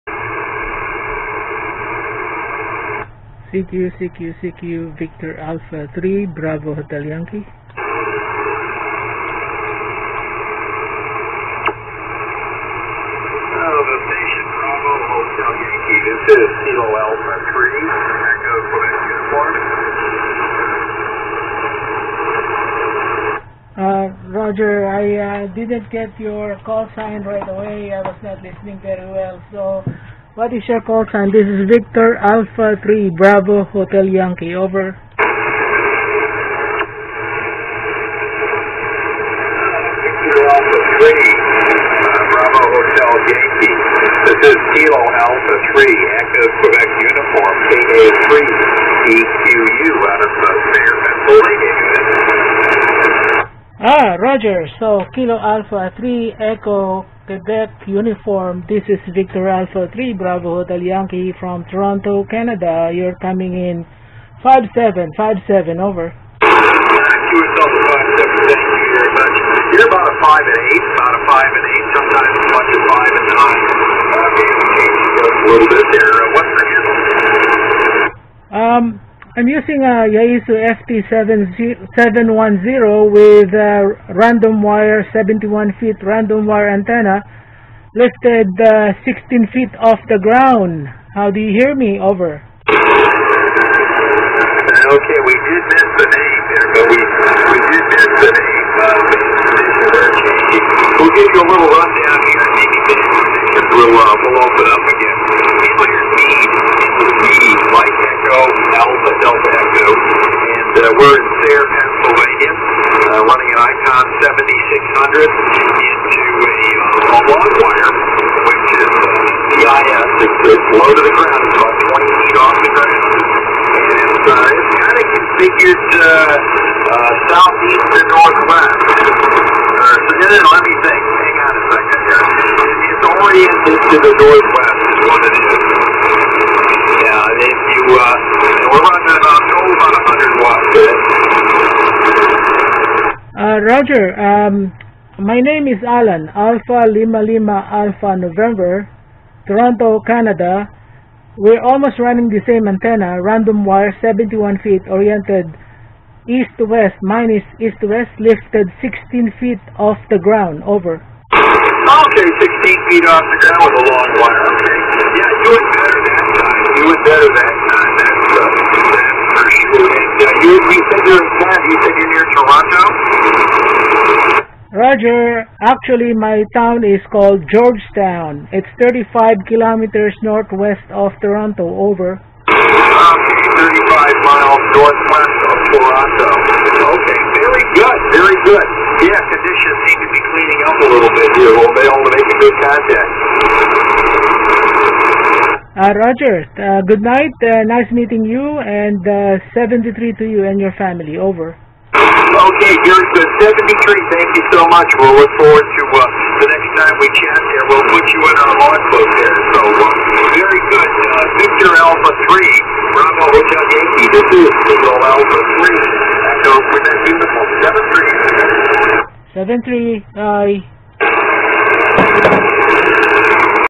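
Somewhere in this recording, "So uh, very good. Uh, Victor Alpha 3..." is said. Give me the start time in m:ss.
3:29.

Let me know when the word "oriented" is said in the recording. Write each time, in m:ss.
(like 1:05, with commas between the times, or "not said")
2:13, 2:34.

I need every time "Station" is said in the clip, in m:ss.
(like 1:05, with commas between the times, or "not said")
0:07.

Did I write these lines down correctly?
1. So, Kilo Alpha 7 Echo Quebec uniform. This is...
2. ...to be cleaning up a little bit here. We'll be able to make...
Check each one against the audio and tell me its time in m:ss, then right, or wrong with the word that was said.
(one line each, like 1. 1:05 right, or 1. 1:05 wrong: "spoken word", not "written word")
1. 0:54 wrong: "3", not "7"
2. 3:10 right.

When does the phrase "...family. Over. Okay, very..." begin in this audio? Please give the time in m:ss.
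3:20.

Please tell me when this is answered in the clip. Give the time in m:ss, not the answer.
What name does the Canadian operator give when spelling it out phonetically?
2:25.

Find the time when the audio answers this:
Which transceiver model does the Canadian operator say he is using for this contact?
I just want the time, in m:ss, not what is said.
1:20.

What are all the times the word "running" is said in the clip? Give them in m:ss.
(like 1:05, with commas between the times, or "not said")
2:18, 2:31.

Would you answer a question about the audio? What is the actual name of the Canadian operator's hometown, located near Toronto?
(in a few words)
Georgetown.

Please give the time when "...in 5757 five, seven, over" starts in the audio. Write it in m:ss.
1:03.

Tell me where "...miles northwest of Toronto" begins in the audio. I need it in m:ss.
3:04.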